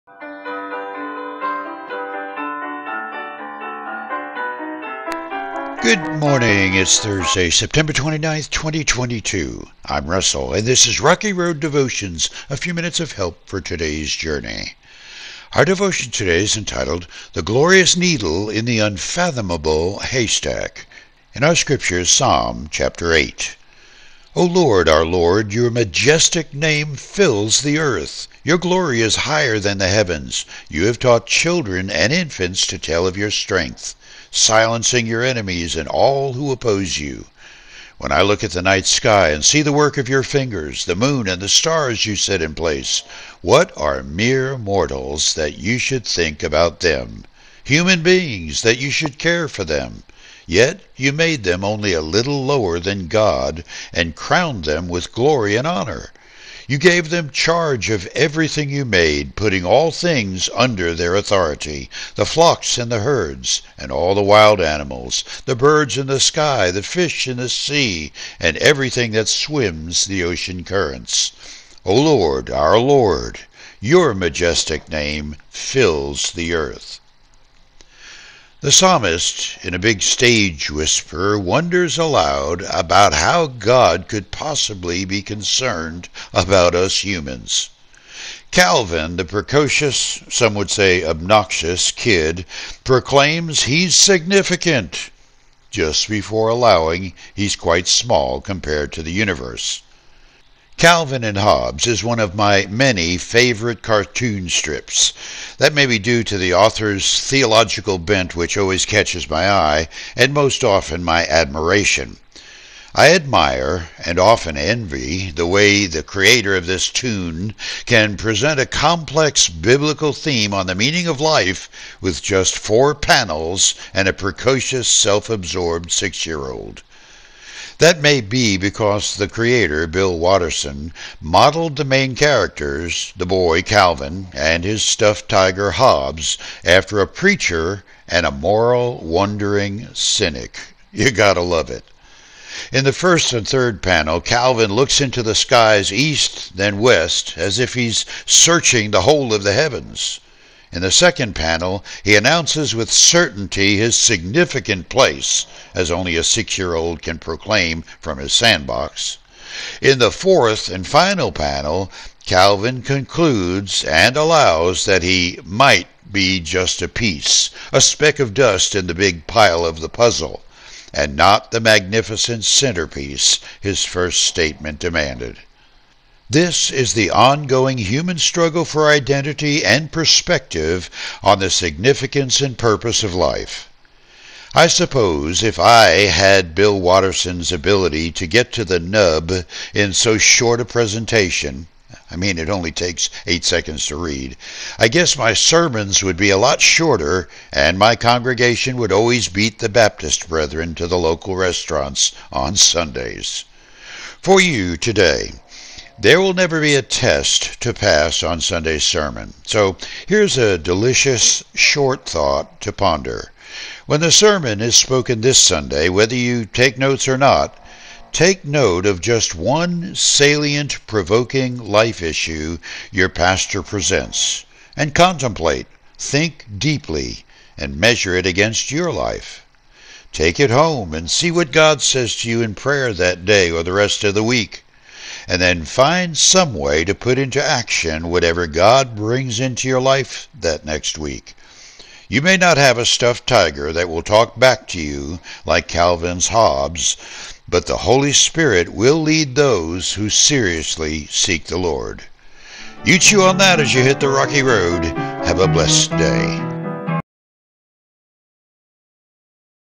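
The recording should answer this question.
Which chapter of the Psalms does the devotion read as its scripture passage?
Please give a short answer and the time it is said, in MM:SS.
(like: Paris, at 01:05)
Psalm 8, at 00:22.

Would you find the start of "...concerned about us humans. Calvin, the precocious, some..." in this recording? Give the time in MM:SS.
01:25.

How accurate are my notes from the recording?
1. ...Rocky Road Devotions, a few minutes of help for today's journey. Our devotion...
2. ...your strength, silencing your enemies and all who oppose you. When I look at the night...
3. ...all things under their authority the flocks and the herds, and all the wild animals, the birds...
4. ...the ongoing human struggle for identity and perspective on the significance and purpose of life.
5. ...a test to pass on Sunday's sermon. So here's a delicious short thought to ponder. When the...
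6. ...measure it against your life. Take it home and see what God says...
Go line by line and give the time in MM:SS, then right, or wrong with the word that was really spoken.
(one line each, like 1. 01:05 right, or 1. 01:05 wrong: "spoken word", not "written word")
1. 00:11 right
2. 00:33 right
3. 00:59 right
4. 02:56 right
5. 03:26 right
6. 03:47 right.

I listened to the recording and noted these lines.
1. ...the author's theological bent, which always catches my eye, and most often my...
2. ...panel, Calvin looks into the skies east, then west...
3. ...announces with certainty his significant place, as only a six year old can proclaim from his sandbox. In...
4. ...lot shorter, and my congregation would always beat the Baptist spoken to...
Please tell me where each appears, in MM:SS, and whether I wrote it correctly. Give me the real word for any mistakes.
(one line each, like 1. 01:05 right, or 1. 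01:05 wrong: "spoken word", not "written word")
1. 01:46 right
2. 02:23 right
3. 02:32 right
4. 03:16 wrong: "brethren", not "spoken".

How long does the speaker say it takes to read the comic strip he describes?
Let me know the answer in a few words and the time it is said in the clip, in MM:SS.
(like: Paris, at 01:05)
8 seconds, at 03:13.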